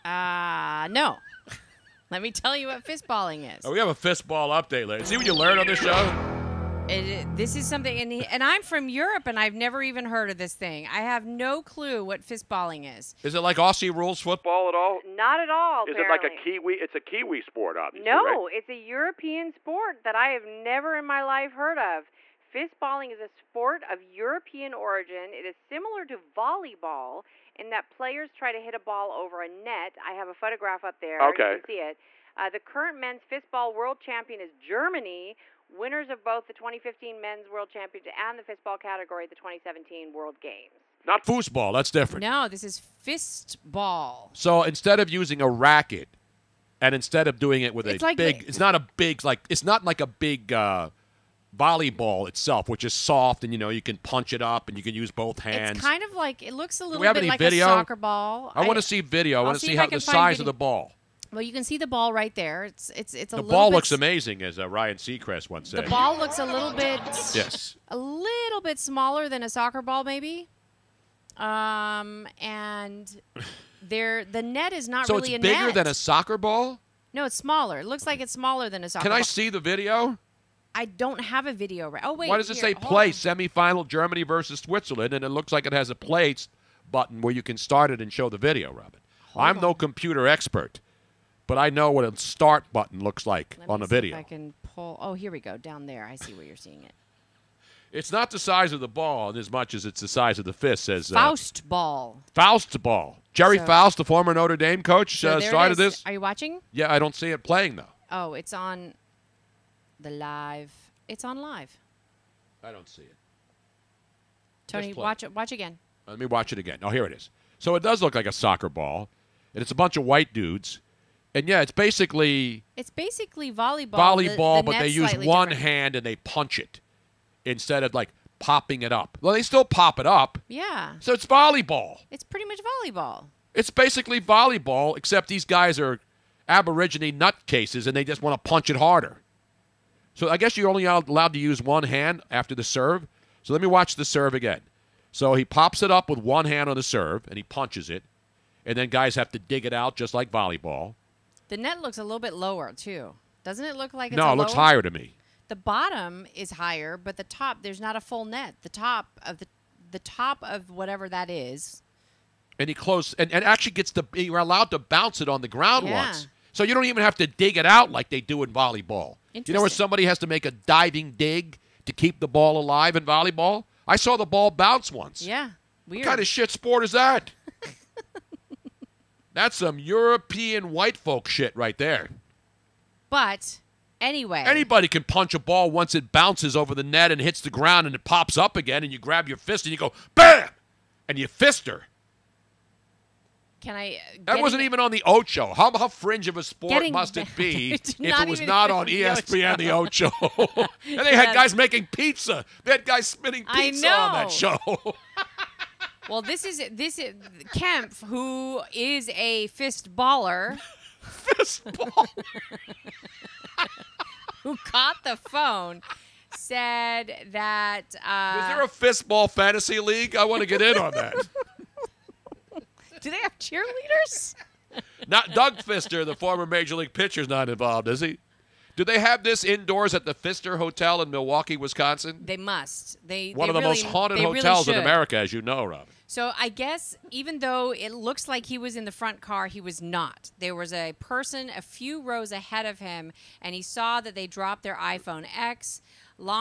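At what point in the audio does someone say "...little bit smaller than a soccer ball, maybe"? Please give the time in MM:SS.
01:07.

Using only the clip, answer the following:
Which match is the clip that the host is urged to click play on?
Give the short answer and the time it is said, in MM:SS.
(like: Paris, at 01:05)
Germany versus Switzerland, at 01:23.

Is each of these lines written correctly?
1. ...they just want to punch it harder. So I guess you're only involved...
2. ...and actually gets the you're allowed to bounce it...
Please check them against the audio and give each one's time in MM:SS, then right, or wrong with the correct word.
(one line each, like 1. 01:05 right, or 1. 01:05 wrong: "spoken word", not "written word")
1. 02:17 wrong: "allowed", not "involved"
2. 02:43 right.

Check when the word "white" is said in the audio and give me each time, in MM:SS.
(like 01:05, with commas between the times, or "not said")
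02:00, 03:00.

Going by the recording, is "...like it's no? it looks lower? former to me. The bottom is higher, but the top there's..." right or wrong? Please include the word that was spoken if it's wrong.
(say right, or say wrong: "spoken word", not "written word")
wrong: "higher", not "former".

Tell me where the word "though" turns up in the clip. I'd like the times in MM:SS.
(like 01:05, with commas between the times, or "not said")
01:47, 03:57.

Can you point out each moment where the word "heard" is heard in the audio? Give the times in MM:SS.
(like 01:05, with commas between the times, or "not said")
00:10, 00:21.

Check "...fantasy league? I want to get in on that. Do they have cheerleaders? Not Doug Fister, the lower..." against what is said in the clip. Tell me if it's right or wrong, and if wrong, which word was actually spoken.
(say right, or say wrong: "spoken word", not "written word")
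wrong: "former", not "lower".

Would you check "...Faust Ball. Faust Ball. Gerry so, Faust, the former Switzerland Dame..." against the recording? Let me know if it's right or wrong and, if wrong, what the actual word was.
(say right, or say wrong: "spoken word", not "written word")
wrong: "Notre", not "Switzerland".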